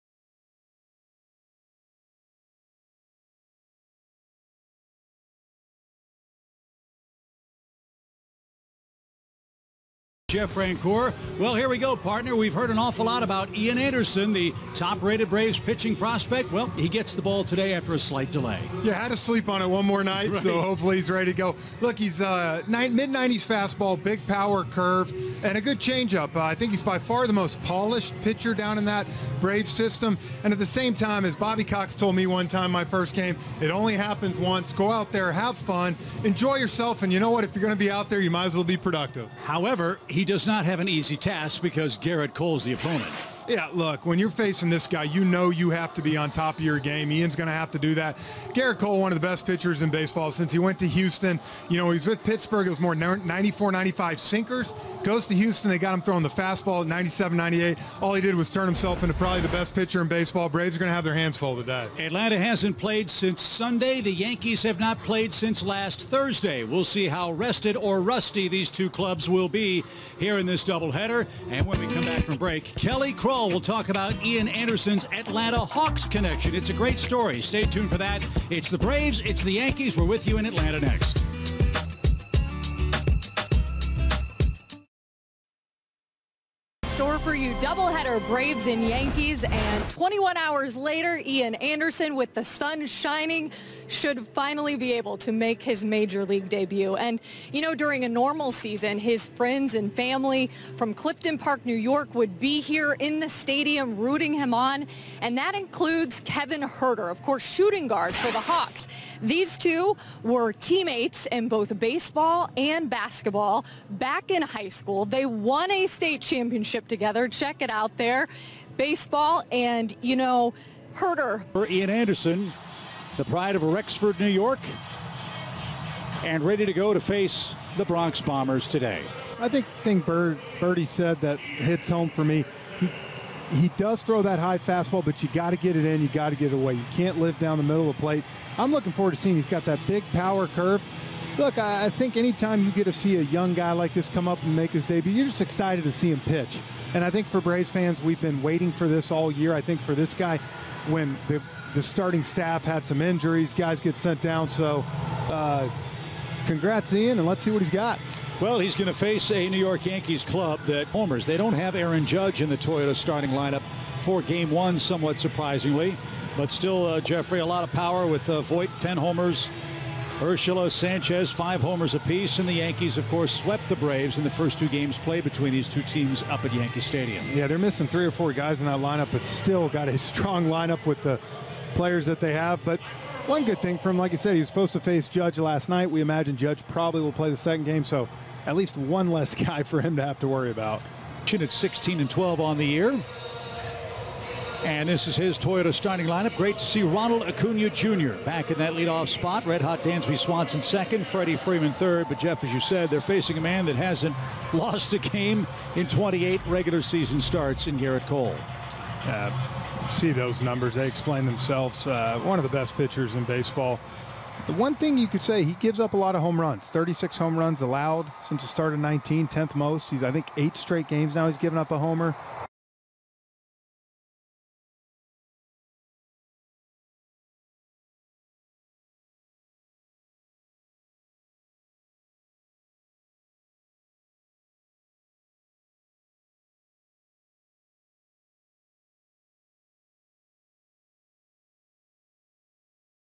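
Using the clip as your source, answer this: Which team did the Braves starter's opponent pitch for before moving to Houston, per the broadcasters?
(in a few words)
Pittsburgh.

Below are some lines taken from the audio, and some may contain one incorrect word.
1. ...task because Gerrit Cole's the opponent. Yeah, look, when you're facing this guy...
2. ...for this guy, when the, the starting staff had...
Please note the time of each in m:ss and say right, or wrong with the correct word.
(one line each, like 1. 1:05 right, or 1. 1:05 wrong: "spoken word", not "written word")
1. 0:41 right
2. 2:29 right.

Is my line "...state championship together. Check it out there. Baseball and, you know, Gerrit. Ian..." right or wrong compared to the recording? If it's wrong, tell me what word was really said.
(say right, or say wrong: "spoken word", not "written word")
wrong: "Huerter", not "Gerrit".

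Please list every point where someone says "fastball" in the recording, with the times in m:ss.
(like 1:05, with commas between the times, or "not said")
0:23, 0:56, 2:14.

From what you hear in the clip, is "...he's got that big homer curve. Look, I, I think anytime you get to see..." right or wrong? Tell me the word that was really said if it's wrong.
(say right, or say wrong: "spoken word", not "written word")
wrong: "power", not "homer".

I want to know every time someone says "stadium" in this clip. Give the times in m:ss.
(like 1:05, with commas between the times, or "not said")
1:43, 2:56.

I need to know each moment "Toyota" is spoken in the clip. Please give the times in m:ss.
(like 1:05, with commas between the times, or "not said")
2:42, 3:15.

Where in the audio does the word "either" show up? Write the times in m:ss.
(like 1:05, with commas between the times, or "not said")
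not said.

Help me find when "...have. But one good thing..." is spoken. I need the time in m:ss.
3:02.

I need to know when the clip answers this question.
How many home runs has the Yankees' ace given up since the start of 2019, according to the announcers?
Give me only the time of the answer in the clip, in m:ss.
3:36.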